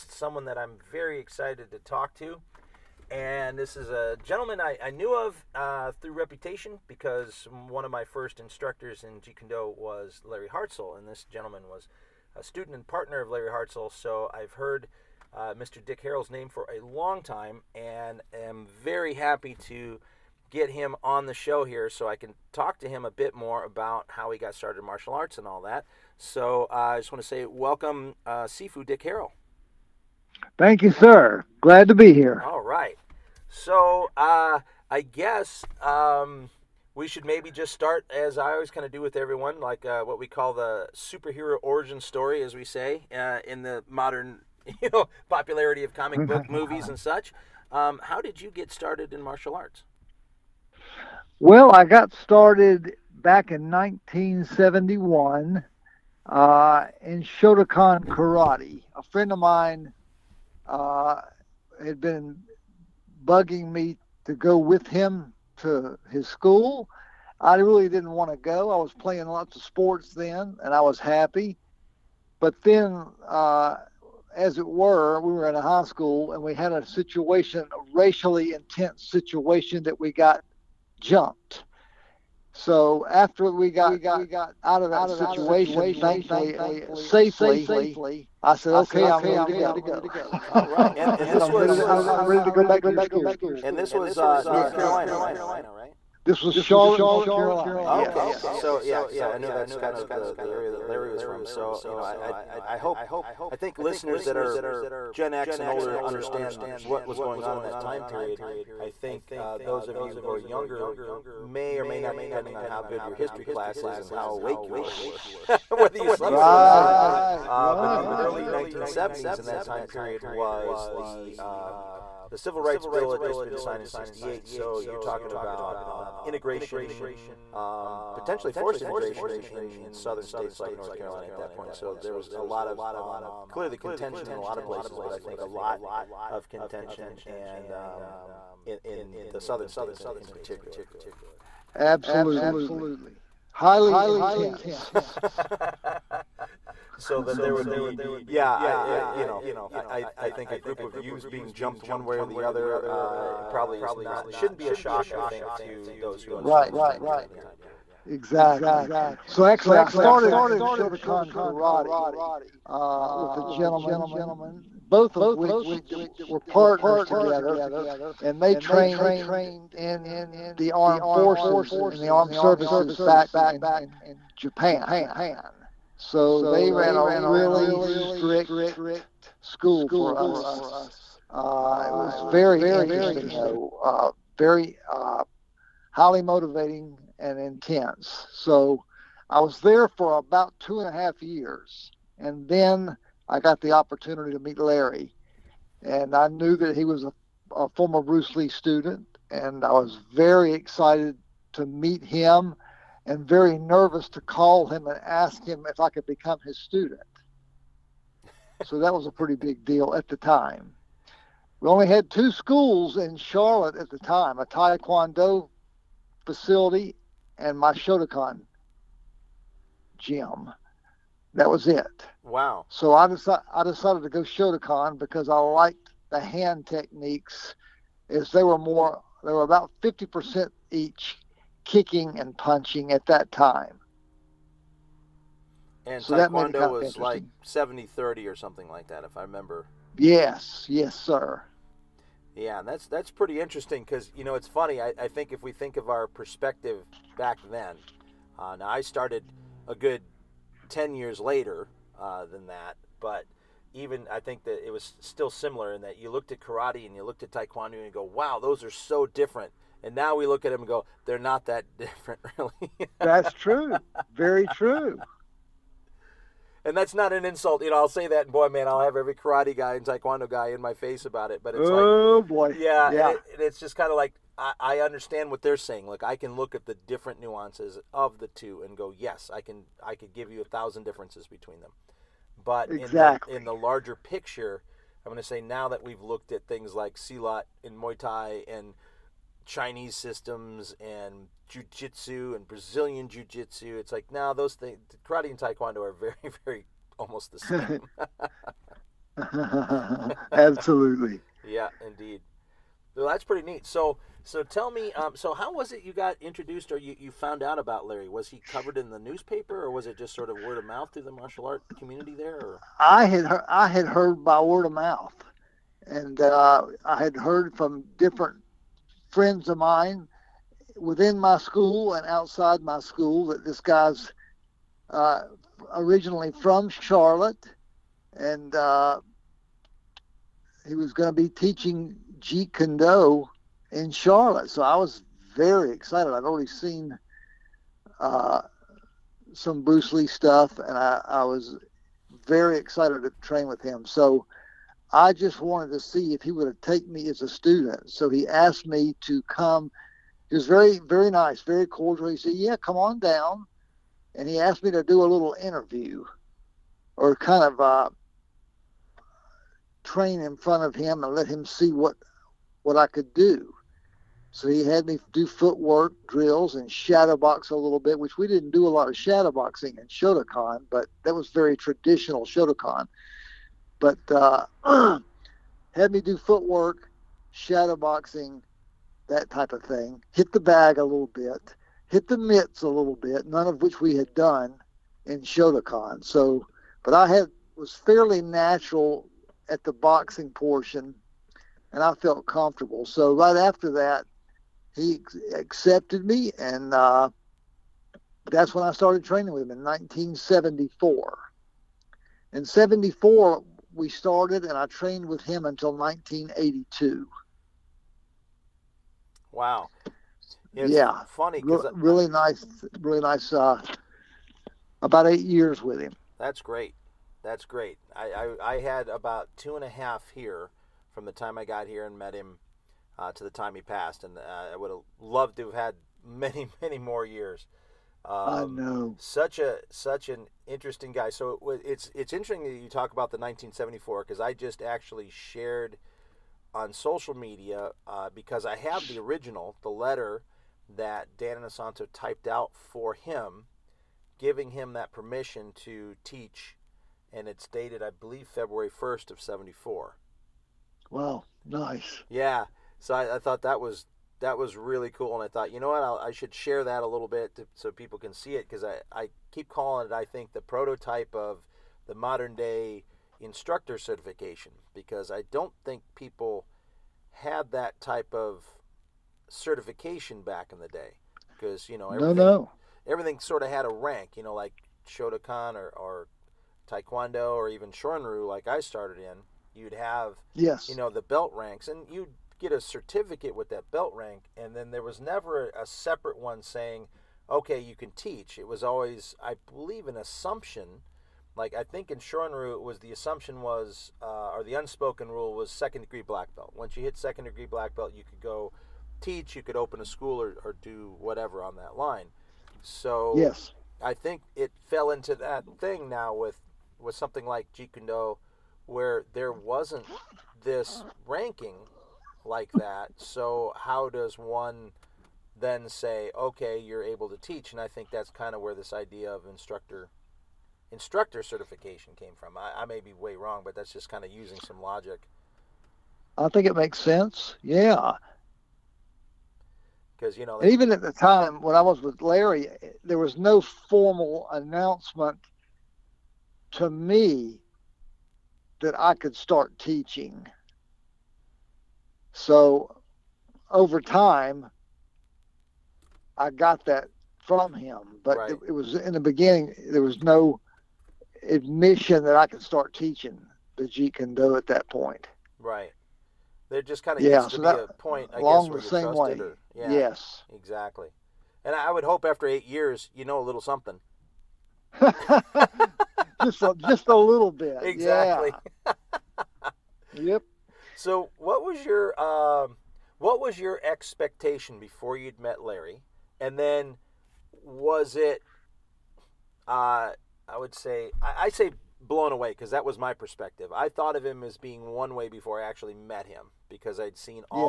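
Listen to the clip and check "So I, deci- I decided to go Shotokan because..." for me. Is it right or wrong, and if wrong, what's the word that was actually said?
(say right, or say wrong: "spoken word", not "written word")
right.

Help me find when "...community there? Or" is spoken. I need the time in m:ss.
5:11.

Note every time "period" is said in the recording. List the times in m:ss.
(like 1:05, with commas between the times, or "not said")
1:48, 1:59, 2:37.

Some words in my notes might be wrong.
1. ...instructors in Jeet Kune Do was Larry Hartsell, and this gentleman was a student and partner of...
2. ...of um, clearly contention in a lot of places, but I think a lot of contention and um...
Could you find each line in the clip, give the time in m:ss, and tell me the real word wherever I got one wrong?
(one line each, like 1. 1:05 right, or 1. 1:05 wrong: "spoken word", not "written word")
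1. 0:08 right
2. 2:12 right.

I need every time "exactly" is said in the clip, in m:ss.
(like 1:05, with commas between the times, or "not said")
2:38, 4:42, 9:20, 9:27.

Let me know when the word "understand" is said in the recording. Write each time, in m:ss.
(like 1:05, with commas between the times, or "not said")
1:46, 2:36, 4:34.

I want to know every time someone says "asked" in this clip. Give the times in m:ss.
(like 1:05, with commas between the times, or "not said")
5:48, 5:54.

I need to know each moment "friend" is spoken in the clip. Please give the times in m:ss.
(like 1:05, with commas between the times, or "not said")
0:59, 5:19.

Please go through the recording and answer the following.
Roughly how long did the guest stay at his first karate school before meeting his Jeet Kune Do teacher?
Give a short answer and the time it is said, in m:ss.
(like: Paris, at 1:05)
two and a half years, at 3:10.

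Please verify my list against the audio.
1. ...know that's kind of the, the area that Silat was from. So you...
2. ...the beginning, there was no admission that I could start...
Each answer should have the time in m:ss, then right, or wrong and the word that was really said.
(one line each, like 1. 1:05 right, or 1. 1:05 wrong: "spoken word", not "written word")
1. 1:39 wrong: "Larry", not "Silat"
2. 9:08 right.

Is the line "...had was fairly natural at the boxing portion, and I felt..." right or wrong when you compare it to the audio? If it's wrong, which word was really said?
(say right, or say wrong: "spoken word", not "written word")
right.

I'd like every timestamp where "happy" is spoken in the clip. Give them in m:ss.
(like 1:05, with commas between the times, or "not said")
0:19, 1:10.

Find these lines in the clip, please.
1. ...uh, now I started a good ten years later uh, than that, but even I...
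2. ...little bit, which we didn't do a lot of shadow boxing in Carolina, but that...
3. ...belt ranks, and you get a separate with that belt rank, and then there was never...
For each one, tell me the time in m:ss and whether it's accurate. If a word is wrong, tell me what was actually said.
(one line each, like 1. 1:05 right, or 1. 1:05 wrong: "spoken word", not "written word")
1. 4:08 right
2. 6:07 wrong: "Shotokan", not "Carolina"
3. 8:01 wrong: "certificate", not "separate".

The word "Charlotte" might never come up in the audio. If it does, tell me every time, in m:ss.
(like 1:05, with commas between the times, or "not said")
1:36, 3:33, 5:26, 5:33.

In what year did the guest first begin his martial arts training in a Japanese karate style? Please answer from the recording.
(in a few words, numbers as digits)
1971.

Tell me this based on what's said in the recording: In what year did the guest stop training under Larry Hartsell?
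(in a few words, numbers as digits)
1982.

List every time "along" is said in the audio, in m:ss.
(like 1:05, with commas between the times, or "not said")
9:18.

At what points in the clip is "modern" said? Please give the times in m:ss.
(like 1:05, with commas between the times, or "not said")
0:43, 7:41.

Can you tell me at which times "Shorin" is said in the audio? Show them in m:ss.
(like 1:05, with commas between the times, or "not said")
7:57, 8:11.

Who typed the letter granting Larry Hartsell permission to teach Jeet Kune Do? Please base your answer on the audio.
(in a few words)
Dan Inosanto.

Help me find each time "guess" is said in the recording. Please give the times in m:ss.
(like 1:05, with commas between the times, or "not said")
0:35, 9:18.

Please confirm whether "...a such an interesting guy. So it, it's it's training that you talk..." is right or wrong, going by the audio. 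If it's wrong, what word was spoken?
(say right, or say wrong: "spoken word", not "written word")
wrong: "interesting", not "training".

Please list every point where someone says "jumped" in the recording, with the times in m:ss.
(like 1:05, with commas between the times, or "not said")
1:20, 2:31.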